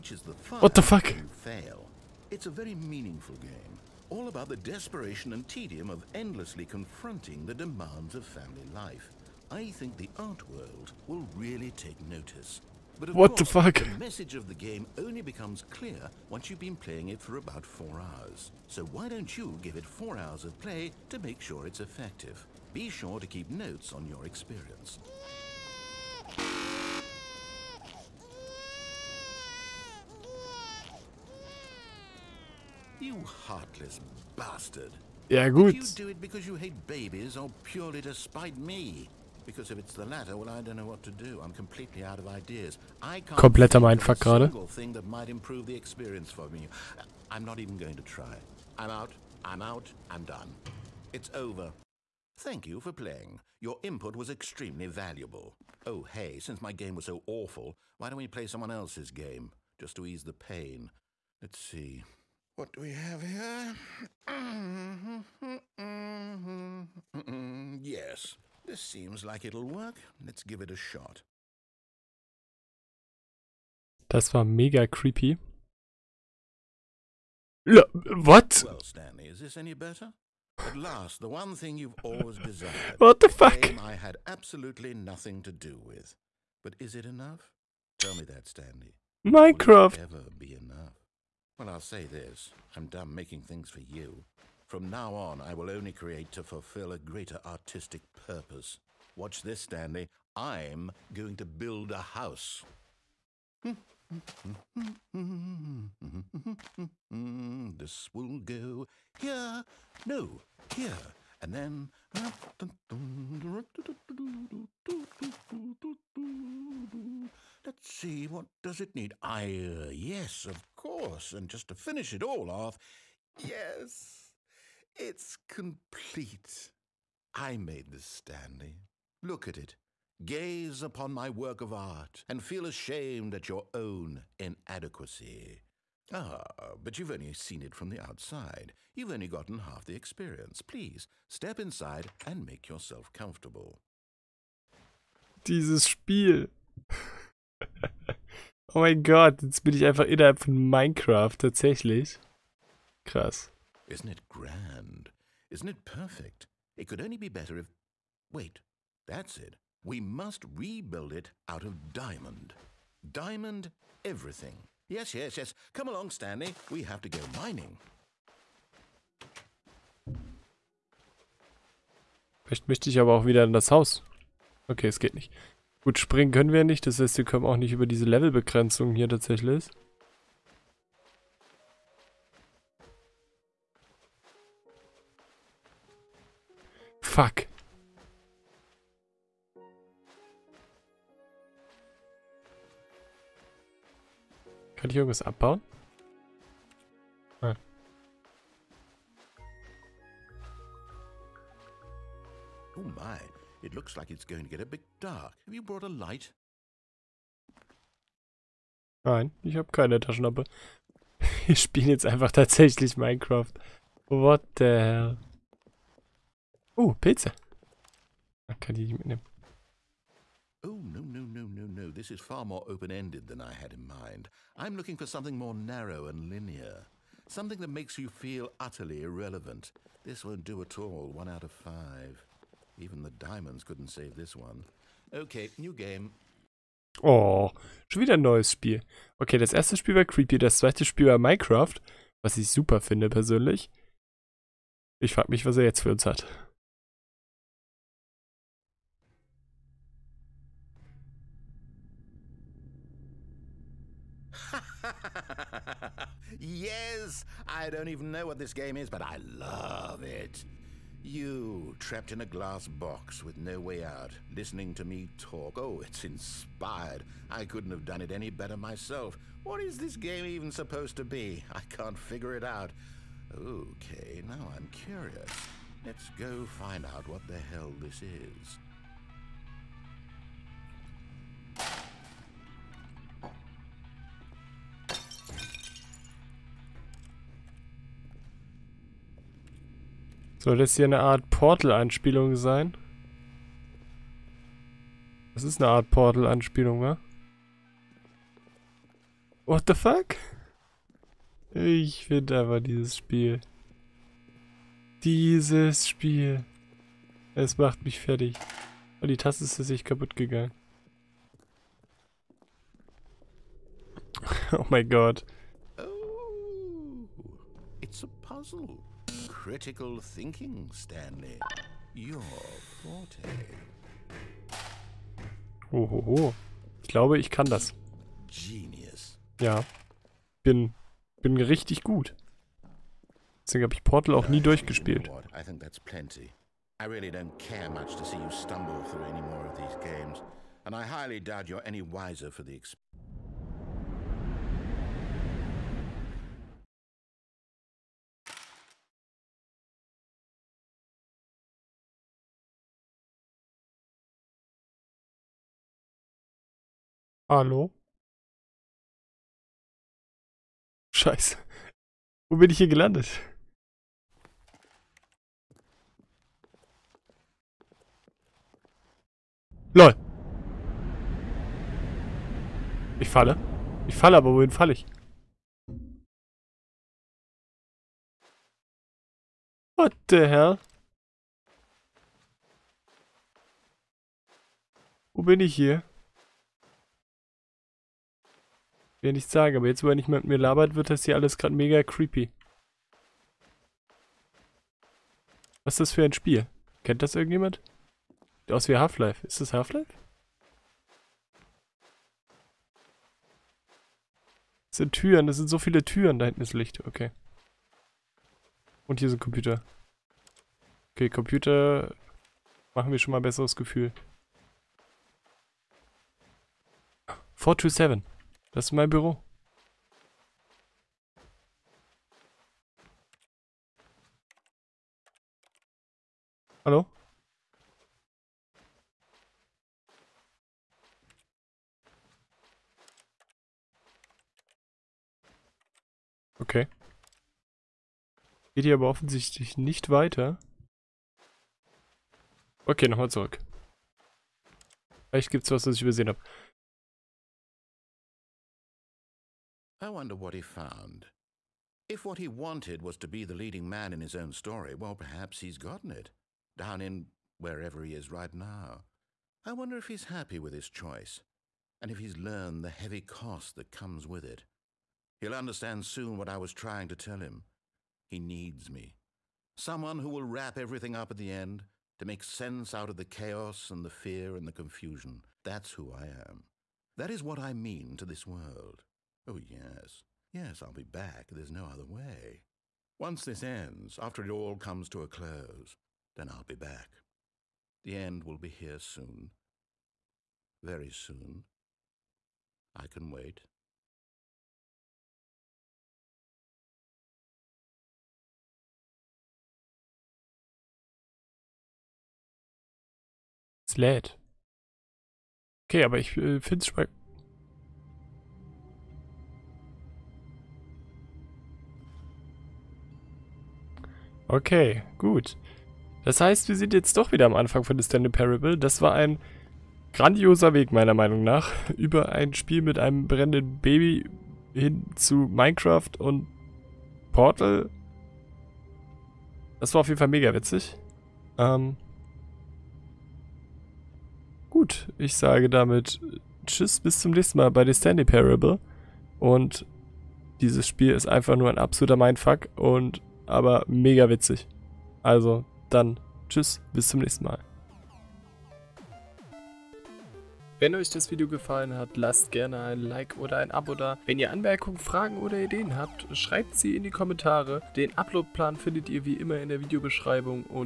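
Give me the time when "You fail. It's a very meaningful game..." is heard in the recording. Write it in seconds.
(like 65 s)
1 s.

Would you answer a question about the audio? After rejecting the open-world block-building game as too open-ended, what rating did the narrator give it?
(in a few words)
1 out of 5.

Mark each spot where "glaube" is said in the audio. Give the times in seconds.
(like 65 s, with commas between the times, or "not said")
326 s.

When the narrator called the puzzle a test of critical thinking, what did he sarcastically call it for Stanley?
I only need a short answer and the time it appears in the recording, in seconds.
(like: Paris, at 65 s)
Your forte, at 321 s.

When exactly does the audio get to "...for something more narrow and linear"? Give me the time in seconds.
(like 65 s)
224 s.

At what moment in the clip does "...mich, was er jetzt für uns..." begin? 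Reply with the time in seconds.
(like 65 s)
245 s.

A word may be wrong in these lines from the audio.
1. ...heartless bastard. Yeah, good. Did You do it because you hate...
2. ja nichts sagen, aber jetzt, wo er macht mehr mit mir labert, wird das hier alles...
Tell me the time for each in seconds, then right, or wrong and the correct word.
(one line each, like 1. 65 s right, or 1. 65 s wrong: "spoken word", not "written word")
1. 33 s right
2. 389 s wrong: "nicht", not "macht".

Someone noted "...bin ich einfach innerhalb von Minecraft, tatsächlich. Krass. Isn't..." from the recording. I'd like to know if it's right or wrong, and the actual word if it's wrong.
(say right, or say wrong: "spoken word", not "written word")
right.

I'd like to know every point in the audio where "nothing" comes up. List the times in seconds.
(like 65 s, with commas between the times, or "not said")
84 s.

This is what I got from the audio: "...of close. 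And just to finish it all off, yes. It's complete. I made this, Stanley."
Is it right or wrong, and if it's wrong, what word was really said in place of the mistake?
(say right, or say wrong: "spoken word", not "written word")
wrong: "course", not "close".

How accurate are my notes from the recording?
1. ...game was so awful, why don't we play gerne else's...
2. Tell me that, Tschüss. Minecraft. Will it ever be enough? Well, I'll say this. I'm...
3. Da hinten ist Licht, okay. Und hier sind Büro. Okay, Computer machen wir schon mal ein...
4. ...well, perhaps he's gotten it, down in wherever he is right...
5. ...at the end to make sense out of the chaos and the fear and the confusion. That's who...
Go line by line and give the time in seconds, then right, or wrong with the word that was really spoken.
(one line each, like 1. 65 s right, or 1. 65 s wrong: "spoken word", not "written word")
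1. 56 s wrong: "someone", not "gerne"
2. 87 s wrong: "Stanley", not "Tschüss"
3. 406 s wrong: "Computer", not "Büro"
4. 454 s right
5. 471 s right.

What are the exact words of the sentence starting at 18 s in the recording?
So why don't you give it four hours of play to make sure it's effective?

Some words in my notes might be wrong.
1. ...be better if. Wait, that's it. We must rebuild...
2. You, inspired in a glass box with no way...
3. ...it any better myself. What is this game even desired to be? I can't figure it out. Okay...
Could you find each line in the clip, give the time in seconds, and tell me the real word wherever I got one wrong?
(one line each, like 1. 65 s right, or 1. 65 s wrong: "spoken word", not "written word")
1. 157 s right
2. 261 s wrong: "trapped", not "inspired"
3. 268 s wrong: "supposed", not "desired".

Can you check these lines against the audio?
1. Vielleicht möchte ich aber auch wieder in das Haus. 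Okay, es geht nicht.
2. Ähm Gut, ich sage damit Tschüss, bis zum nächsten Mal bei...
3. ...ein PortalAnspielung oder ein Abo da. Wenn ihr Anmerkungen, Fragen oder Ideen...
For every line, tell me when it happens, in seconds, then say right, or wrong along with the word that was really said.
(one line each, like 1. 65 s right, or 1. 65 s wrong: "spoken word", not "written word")
1. 172 s right
2. 531 s right
3. 552 s wrong: "Like", not "PortalAnspielung".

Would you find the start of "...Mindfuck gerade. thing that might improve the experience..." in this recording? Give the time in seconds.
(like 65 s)
43 s.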